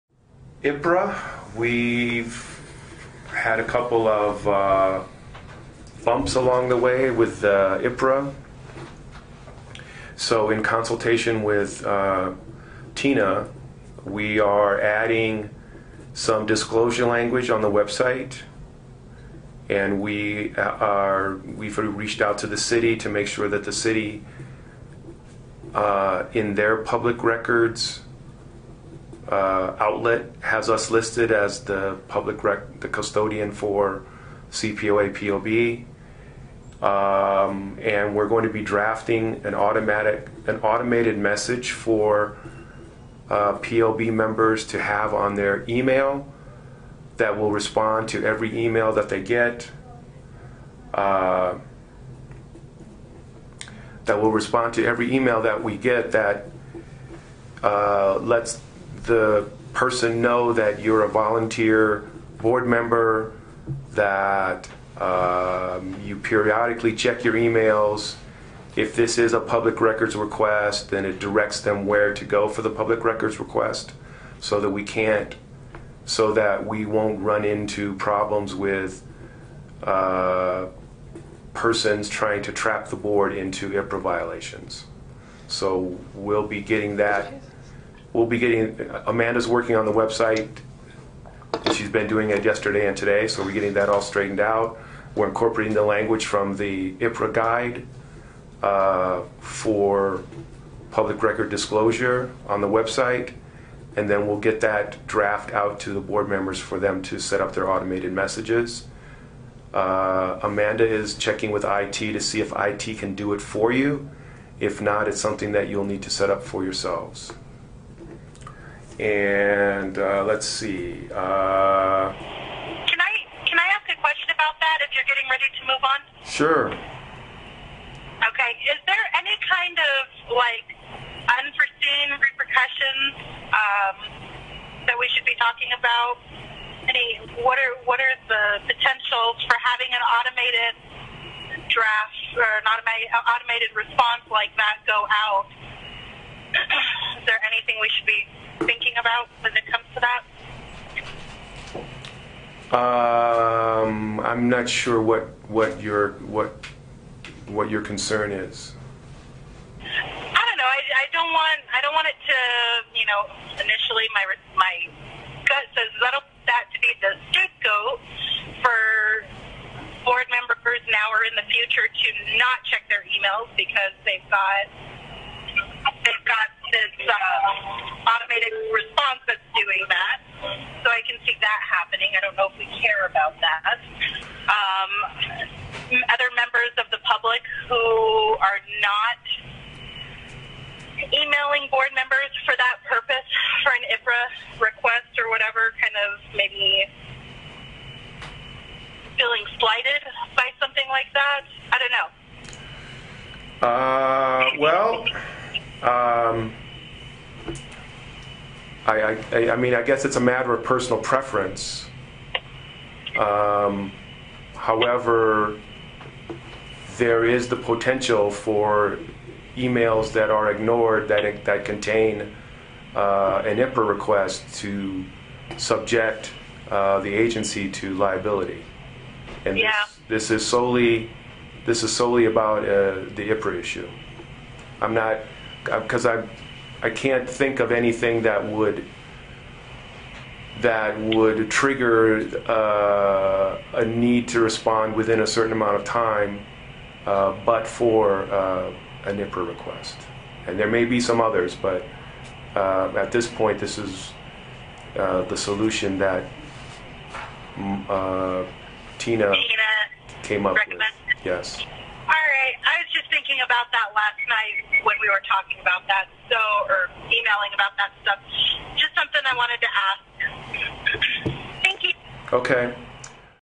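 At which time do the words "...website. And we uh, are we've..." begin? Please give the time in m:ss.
0:17.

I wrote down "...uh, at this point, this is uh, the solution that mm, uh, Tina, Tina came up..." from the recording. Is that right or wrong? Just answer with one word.
right.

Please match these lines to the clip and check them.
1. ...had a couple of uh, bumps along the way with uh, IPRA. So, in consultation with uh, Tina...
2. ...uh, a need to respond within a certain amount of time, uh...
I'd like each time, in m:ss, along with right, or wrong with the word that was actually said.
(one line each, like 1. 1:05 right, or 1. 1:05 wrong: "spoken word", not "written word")
1. 0:03 right
2. 4:02 right.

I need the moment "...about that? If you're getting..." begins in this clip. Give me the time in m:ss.
2:04.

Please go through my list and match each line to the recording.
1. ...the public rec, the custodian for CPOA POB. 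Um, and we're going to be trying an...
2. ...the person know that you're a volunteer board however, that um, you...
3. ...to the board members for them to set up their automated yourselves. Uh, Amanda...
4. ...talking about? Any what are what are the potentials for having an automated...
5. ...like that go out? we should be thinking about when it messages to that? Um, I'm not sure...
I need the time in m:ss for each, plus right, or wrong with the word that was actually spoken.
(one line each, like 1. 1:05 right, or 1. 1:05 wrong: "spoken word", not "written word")
1. 0:31 wrong: "drafting", not "trying"
2. 0:59 wrong: "member", not "however"
3. 1:45 wrong: "messages", not "yourselves"
4. 2:15 right
5. 2:24 wrong: "comes", not "messages".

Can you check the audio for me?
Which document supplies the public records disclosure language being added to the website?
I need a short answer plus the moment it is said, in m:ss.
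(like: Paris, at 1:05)
the IPRA guide, at 1:36.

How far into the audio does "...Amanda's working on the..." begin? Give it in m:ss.
1:29.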